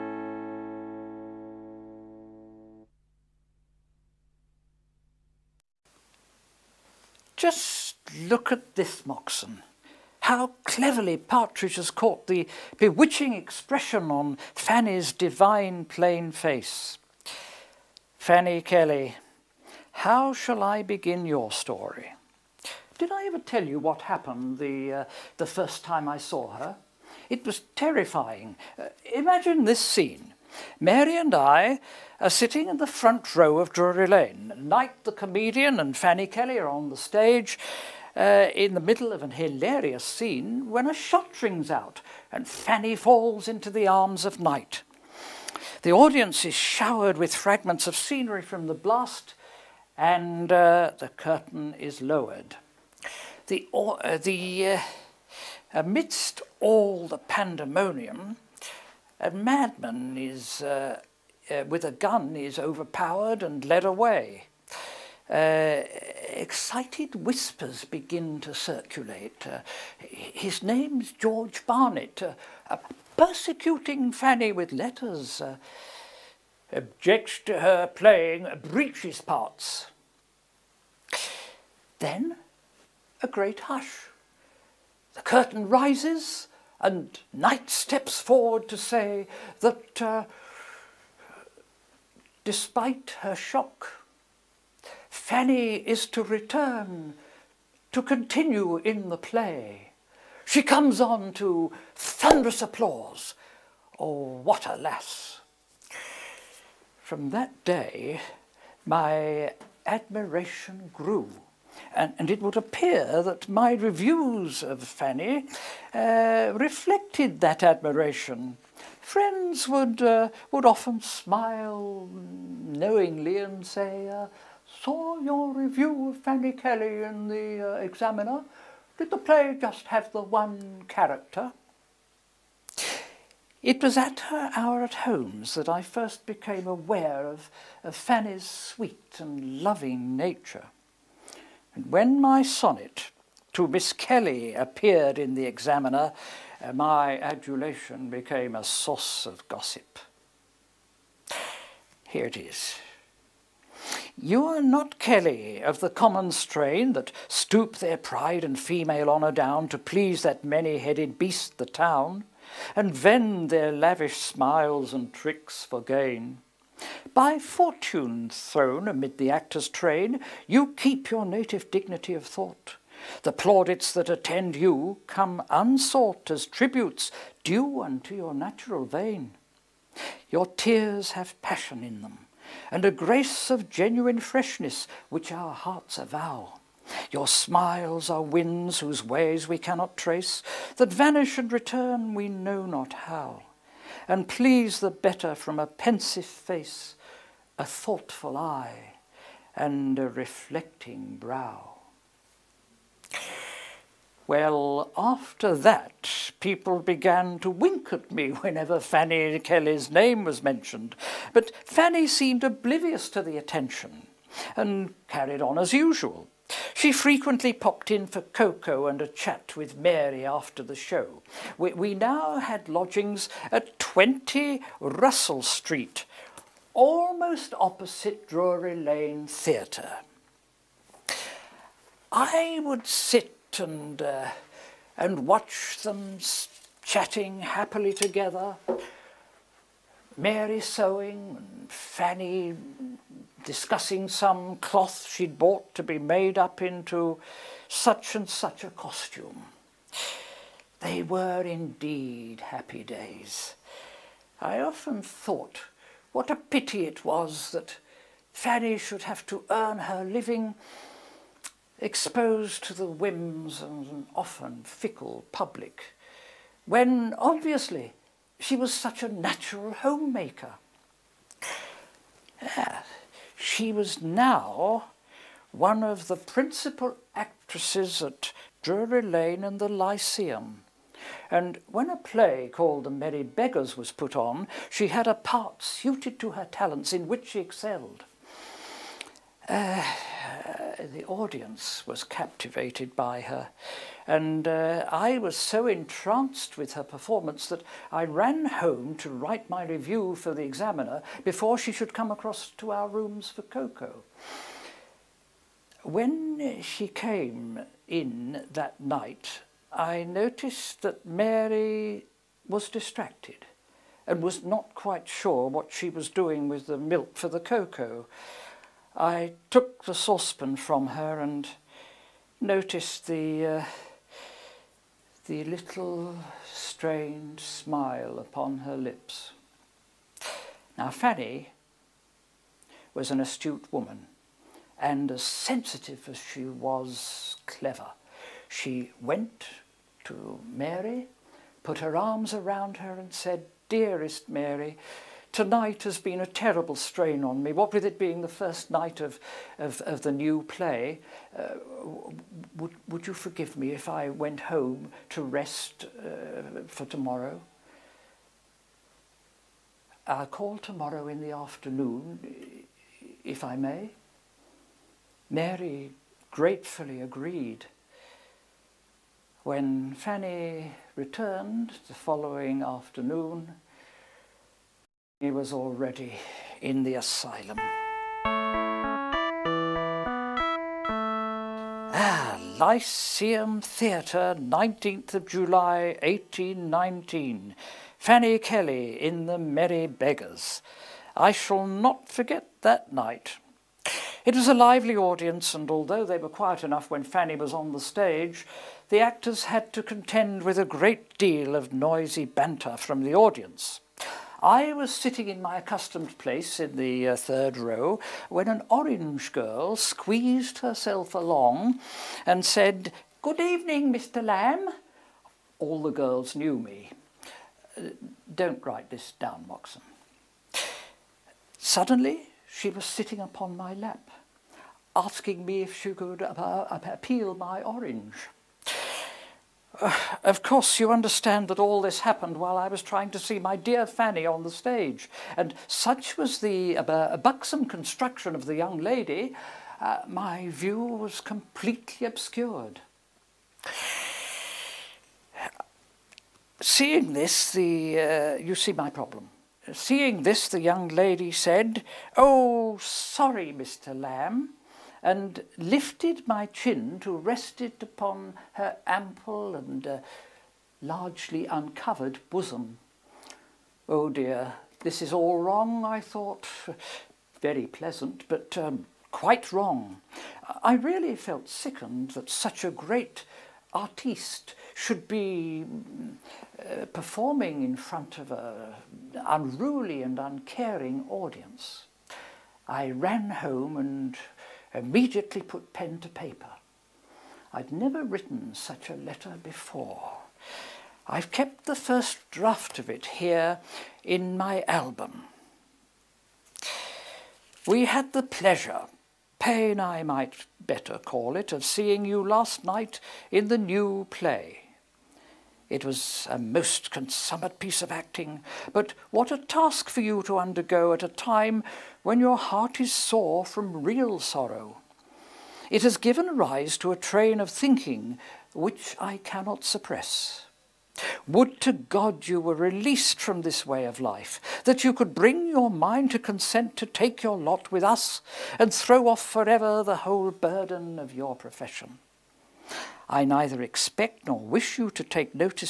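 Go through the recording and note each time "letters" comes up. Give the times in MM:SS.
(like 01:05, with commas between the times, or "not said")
01:14, 08:08.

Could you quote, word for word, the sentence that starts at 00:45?
The audience is showered with fragments of scenery from the blast, and uh, the curtain is lowered.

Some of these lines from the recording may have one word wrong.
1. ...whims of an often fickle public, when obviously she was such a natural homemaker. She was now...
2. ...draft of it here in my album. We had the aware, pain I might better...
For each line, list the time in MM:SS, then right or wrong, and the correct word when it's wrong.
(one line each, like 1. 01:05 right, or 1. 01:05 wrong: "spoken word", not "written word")
1. 04:22 right
2. 08:12 wrong: "pleasure", not "aware".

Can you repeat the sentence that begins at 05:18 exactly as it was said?
I took the saucepan from her and noticed the, uh, the little strained smile upon her lips.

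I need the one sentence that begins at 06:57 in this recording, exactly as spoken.
Uh, don't write this down, Moxon.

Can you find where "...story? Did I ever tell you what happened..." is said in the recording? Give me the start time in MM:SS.
00:21.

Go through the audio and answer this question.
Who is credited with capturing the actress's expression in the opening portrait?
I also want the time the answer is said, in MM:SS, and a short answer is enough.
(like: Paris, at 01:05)
Partridge, at 00:11.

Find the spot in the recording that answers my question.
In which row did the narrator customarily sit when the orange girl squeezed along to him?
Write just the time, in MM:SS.
06:47.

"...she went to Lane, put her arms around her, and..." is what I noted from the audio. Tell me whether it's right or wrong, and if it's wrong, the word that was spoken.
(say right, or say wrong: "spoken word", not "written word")
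wrong: "Mary", not "Lane".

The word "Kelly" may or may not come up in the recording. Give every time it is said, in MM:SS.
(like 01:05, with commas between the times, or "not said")
00:18, 00:36, 02:06, 02:23, 02:34, 03:29, 06:28.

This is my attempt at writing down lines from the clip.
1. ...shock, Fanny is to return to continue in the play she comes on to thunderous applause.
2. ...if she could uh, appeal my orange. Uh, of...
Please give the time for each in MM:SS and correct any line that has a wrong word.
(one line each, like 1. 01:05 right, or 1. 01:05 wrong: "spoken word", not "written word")
1. 01:33 right
2. 07:05 right.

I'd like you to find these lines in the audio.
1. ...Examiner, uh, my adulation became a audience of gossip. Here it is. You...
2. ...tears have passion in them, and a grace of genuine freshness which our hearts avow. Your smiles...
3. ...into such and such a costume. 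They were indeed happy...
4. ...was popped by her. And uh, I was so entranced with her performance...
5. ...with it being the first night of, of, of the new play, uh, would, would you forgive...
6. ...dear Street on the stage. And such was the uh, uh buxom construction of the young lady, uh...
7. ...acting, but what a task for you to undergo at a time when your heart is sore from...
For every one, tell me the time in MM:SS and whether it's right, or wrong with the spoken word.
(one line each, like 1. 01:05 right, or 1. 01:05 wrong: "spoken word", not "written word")
1. 02:25 wrong: "source", not "audience"
2. 03:00 right
3. 04:06 right
4. 04:51 wrong: "captivated", not "popped"
5. 05:47 right
6. 07:13 wrong: "Fanny", not "Street"
7. 08:27 right.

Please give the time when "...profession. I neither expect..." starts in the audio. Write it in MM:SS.
08:51.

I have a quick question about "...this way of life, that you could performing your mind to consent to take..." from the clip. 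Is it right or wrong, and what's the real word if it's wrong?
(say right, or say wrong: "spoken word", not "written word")
wrong: "bring", not "performing".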